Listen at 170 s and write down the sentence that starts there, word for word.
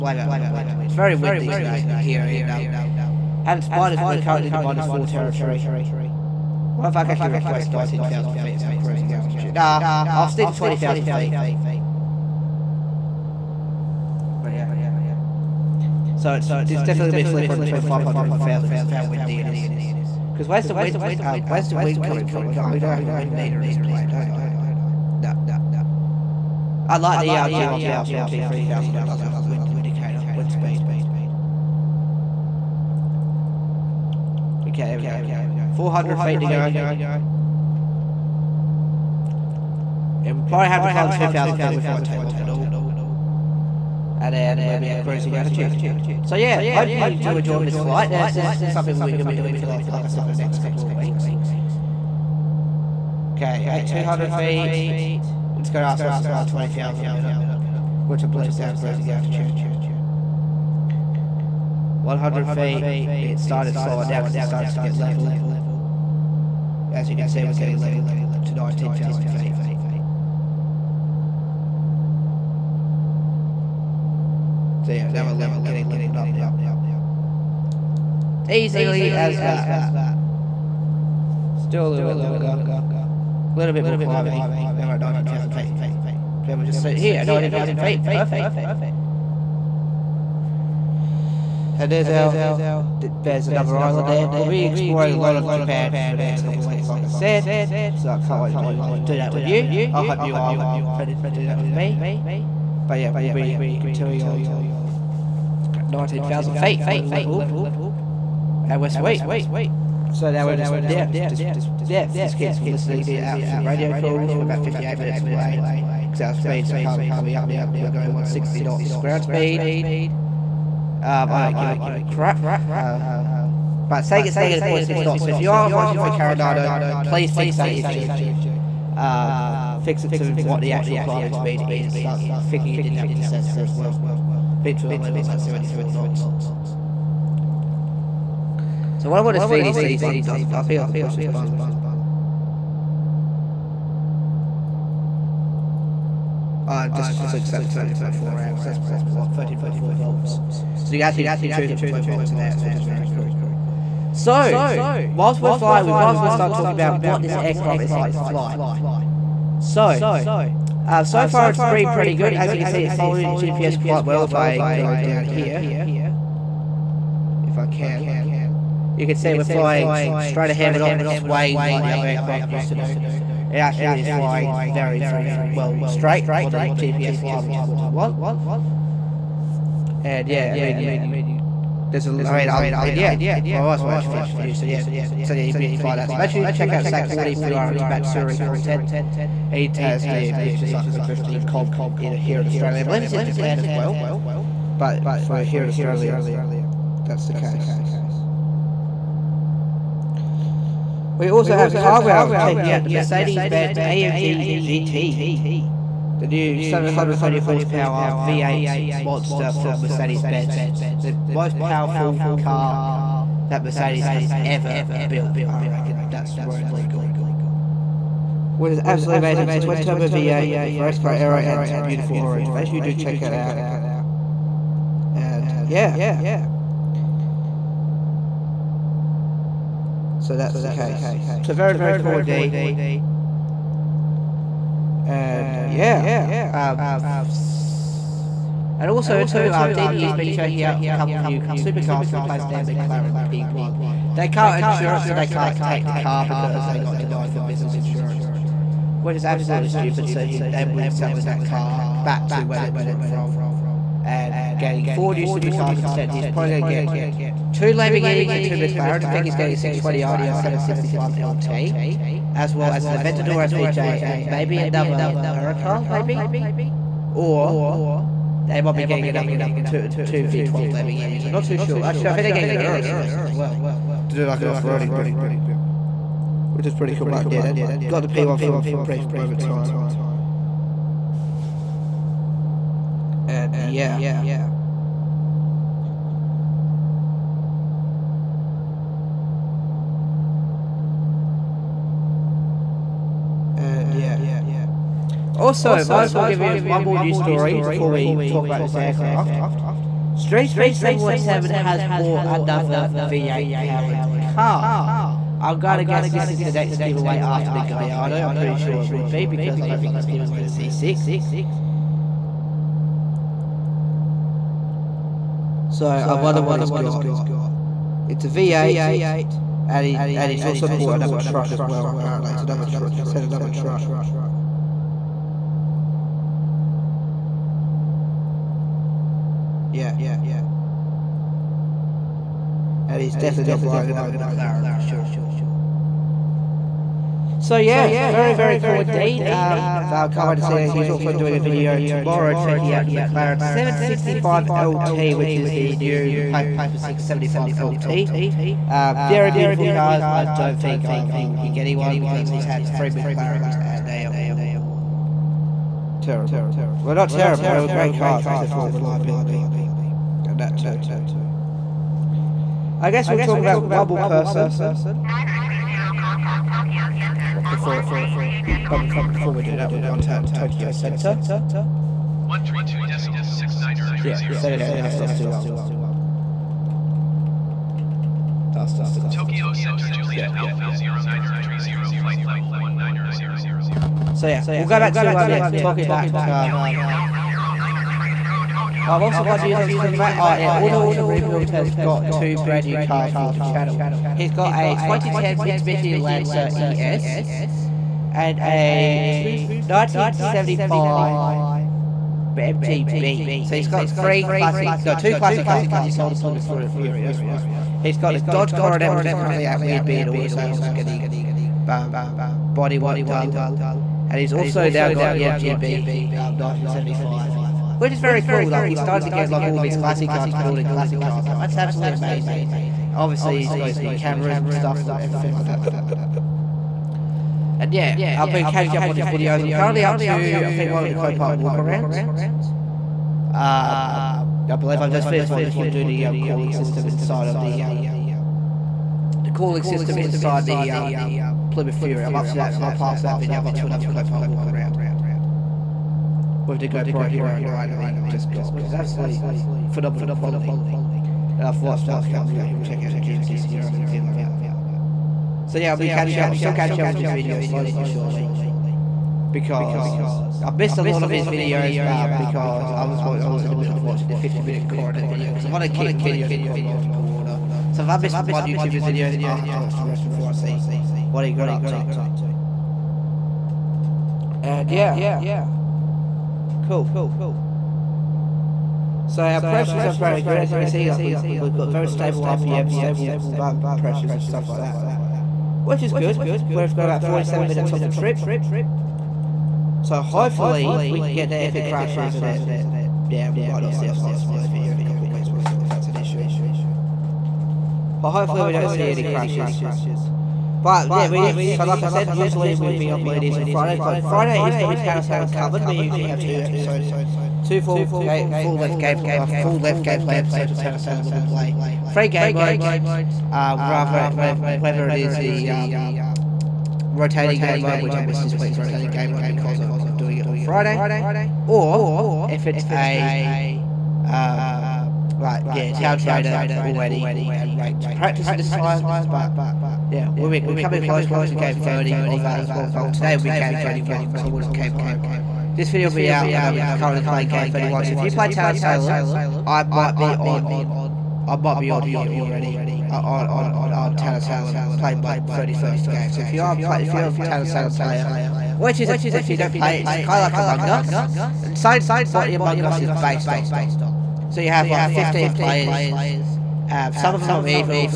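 We're not swaying like the other aircraft used to do.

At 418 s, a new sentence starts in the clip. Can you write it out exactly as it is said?
Like, he's starting to get, like, all of his classic cars, building classic cars.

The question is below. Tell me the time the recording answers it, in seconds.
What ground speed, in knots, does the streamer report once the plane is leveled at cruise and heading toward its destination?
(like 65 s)
118 s.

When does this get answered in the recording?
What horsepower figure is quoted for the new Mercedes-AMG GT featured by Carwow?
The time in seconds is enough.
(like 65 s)
206 s.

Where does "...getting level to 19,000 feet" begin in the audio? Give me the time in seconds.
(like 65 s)
67 s.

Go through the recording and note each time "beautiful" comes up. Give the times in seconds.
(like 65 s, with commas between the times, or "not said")
221 s, 349 s.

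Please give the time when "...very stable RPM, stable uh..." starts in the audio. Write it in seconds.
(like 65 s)
481 s.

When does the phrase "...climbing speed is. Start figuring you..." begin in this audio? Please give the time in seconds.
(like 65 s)
130 s.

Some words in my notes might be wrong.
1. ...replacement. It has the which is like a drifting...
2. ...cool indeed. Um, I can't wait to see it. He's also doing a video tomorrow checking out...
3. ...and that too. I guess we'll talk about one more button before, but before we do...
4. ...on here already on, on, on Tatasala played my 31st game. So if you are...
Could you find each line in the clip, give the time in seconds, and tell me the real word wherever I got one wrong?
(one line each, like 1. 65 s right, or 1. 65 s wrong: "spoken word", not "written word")
1. 188 s wrong: "content", not "replacement"
2. 338 s right
3. 359 s wrong: "person", not "button"
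4. 541 s right.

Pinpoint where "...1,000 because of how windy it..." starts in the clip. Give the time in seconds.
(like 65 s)
18 s.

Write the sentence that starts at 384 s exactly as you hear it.
So yeah, we'll go back to um, yeah talking back to.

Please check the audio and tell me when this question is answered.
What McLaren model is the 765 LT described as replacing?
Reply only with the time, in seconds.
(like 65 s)
346 s.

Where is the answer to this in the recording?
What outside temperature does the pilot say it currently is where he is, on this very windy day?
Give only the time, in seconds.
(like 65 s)
4 s.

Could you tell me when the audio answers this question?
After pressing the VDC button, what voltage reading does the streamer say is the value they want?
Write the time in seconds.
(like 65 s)
149 s.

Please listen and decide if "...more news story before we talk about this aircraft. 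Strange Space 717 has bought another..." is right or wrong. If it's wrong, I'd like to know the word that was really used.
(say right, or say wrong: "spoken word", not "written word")
right.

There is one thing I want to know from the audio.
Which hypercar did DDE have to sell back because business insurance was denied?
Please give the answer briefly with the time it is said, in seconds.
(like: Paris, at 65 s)
McLaren P1, at 242 s.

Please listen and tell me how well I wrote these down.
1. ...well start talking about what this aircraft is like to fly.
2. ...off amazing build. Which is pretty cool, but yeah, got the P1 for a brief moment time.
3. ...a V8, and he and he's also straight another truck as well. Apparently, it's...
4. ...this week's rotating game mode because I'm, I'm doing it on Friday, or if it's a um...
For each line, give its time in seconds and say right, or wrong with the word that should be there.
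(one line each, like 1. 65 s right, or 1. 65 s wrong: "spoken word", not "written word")
1. 156 s right
2. 274 s wrong: "roading", not "amazing"
3. 318 s wrong: "bought", not "straight"
4. 518 s right.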